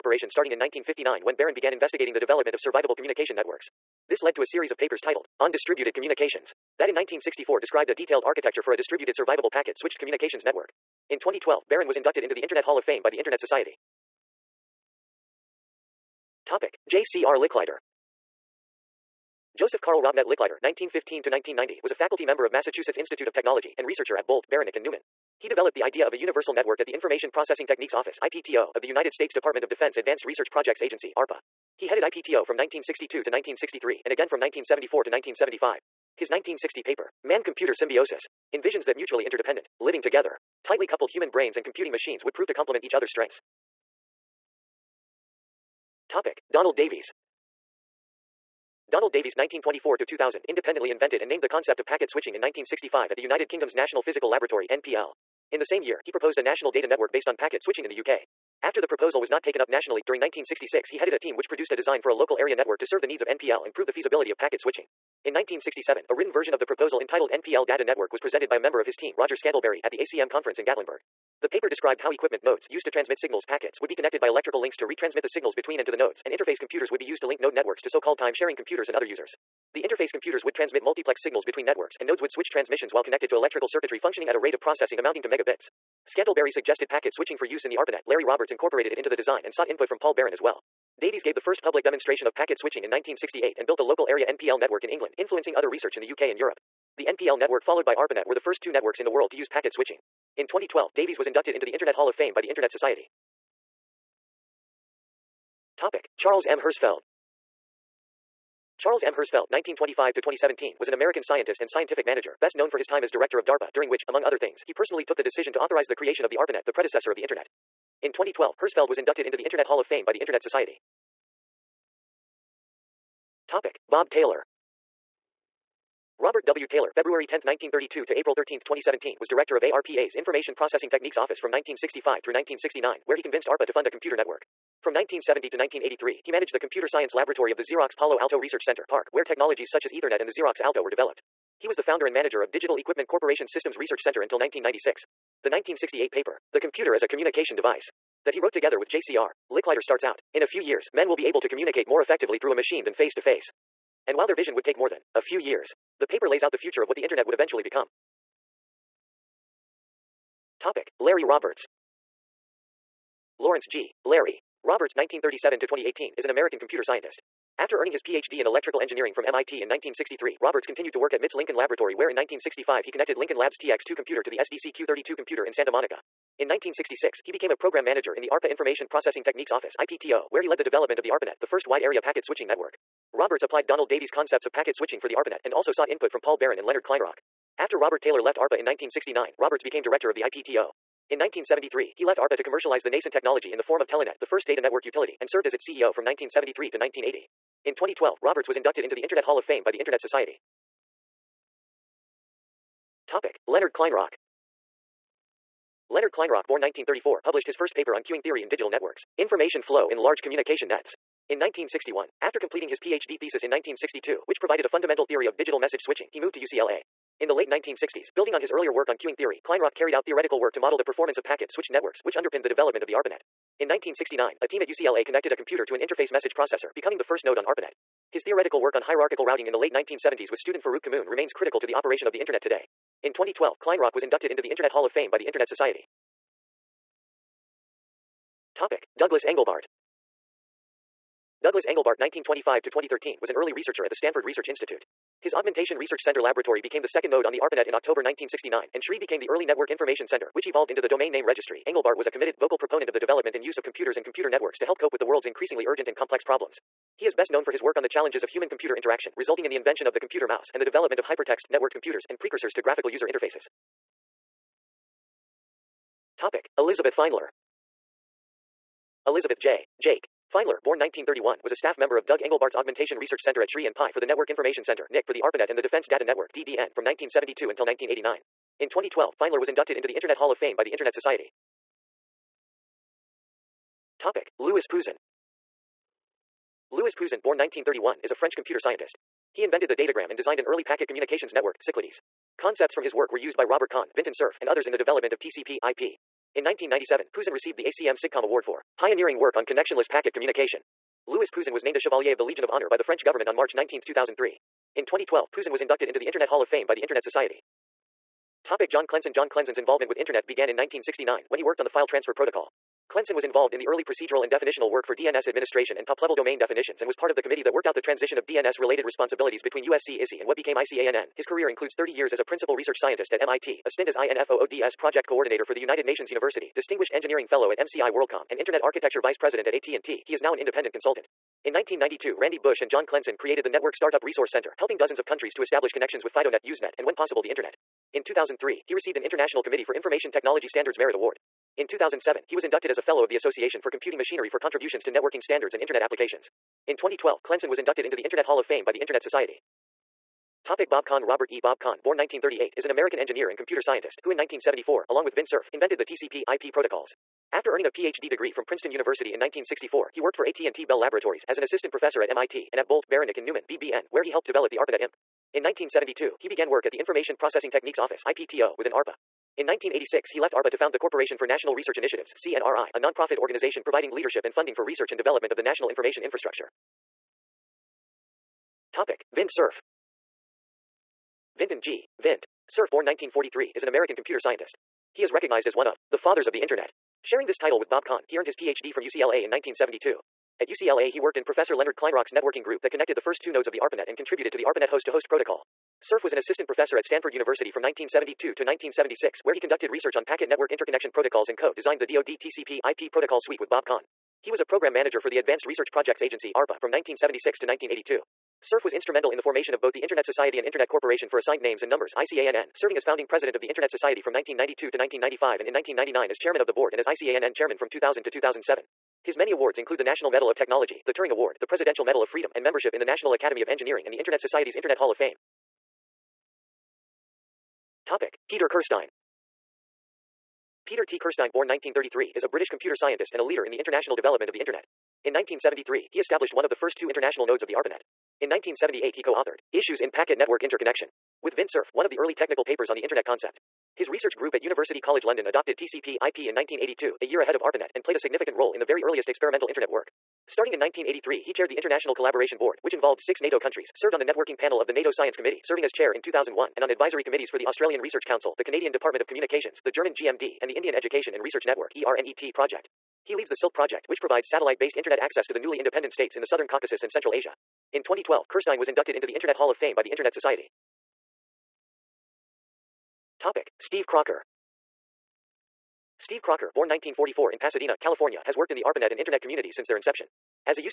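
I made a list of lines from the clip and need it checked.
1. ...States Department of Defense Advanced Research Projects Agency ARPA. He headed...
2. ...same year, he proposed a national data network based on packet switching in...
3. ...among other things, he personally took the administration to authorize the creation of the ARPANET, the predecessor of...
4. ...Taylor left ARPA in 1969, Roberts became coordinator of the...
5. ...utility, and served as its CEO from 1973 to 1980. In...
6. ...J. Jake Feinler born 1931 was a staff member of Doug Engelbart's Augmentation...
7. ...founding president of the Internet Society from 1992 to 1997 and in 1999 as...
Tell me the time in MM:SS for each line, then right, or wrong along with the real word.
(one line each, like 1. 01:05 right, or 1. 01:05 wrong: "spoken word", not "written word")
1. 00:29 right
2. 00:55 right
3. 01:54 wrong: "decision", not "administration"
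4. 03:08 wrong: "director", not "coordinator"
5. 03:14 right
6. 04:29 right
7. 06:52 wrong: "1995", not "1997".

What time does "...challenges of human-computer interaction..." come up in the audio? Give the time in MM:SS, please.
04:17.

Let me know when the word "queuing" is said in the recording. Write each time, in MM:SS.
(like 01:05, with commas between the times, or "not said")
03:28, 03:38.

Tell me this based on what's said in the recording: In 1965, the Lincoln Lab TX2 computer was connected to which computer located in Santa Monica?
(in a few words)
SDC-Q32.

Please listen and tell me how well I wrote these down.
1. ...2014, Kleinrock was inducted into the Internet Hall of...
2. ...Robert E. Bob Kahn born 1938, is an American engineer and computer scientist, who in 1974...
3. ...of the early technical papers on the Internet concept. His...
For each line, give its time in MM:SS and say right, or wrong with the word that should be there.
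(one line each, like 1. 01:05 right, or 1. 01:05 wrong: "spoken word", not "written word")
1. 03:53 wrong: "2012", not "2014"
2. 05:51 right
3. 07:21 right.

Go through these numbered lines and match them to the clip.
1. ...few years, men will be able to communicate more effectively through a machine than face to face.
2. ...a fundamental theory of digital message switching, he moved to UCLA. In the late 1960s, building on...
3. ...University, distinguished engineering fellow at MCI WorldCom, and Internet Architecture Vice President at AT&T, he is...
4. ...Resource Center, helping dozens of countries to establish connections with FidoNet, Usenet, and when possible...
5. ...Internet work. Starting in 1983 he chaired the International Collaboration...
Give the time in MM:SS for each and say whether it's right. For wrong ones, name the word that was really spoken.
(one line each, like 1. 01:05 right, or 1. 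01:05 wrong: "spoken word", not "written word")
1. 02:30 right
2. 03:34 right
3. 05:26 right
4. 05:34 right
5. 07:29 right.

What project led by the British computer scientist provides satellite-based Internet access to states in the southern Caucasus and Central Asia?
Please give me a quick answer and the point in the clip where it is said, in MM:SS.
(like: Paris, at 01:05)
Silk Project, at 07:43.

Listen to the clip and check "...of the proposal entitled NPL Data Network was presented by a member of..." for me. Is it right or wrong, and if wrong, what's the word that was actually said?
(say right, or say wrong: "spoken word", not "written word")
right.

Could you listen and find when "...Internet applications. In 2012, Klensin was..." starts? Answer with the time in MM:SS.
05:45.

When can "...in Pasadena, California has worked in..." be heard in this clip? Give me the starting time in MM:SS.
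07:57.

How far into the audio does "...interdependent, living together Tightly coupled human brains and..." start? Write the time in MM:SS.
00:39.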